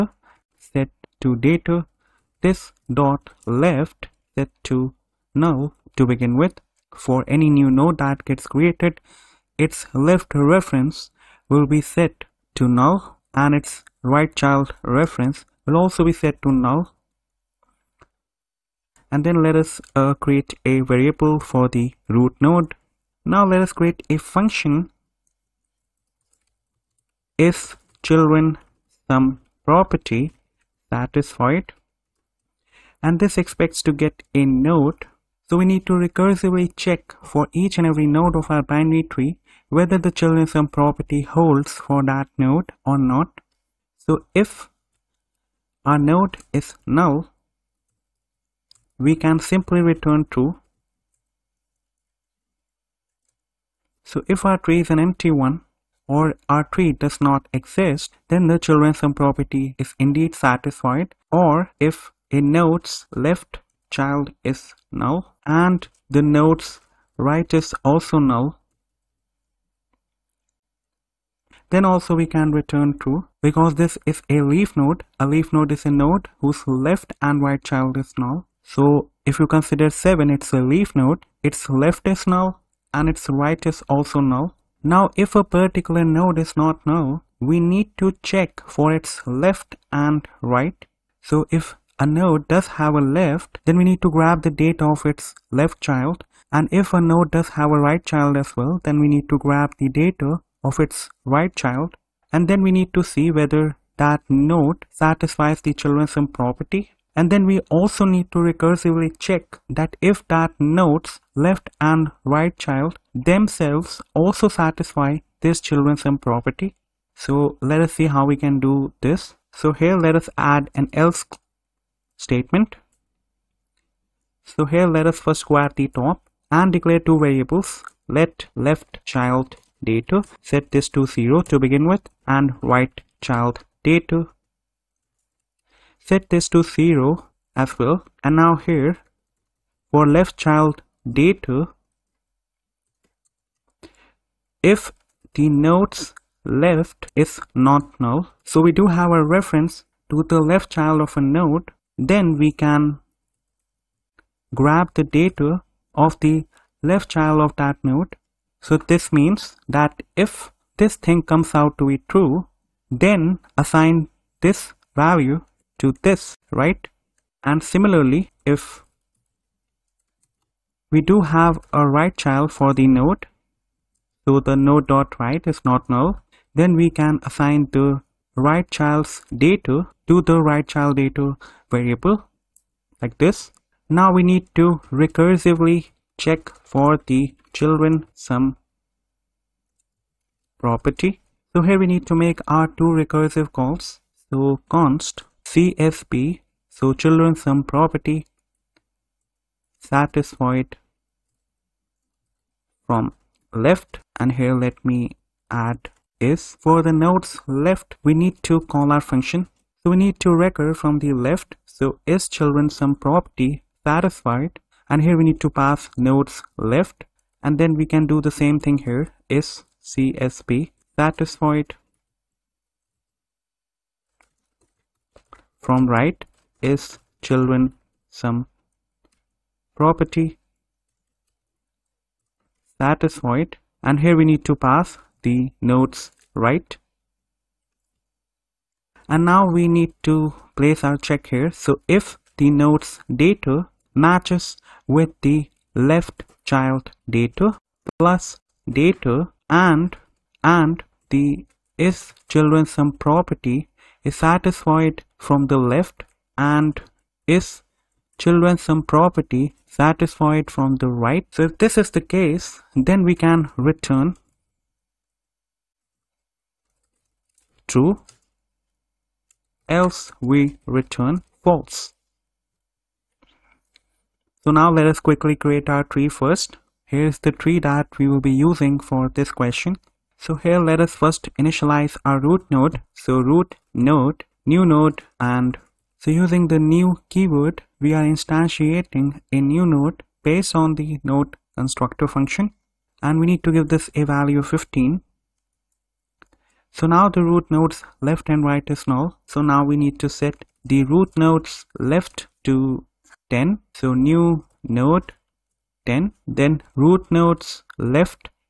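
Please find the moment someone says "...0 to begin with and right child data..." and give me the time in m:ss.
2:11.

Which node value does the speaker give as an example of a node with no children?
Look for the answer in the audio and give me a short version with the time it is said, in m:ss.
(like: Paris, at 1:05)
7, at 1:19.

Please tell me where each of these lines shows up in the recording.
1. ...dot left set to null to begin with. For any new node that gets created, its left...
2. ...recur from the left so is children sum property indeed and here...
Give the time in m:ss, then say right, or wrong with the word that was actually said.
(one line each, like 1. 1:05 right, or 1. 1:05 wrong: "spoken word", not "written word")
1. 0:02 right
2. 3:30 wrong: "satisfied", not "indeed".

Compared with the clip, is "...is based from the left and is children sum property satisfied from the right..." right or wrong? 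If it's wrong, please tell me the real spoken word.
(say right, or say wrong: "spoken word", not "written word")
wrong: "satisfied", not "based".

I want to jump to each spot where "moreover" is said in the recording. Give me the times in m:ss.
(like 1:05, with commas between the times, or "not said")
not said.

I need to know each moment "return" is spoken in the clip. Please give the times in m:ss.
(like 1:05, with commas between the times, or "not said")
0:49, 1:12, 4:23, 4:30.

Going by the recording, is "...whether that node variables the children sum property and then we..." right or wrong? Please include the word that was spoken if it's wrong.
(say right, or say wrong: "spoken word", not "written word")
wrong: "satisfies", not "variables".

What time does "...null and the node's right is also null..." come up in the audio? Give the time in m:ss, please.
1:04.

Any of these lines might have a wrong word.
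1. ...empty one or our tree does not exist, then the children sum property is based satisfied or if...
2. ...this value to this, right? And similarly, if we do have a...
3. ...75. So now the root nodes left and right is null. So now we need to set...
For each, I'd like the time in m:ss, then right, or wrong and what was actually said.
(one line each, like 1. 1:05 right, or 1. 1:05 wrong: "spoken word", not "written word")
1. 0:54 wrong: "indeed", not "based"
2. 2:44 right
3. 4:54 wrong: "15", not "75".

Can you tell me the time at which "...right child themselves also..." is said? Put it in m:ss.
1:52.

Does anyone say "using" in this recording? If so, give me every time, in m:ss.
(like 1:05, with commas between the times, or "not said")
4:38, 4:46.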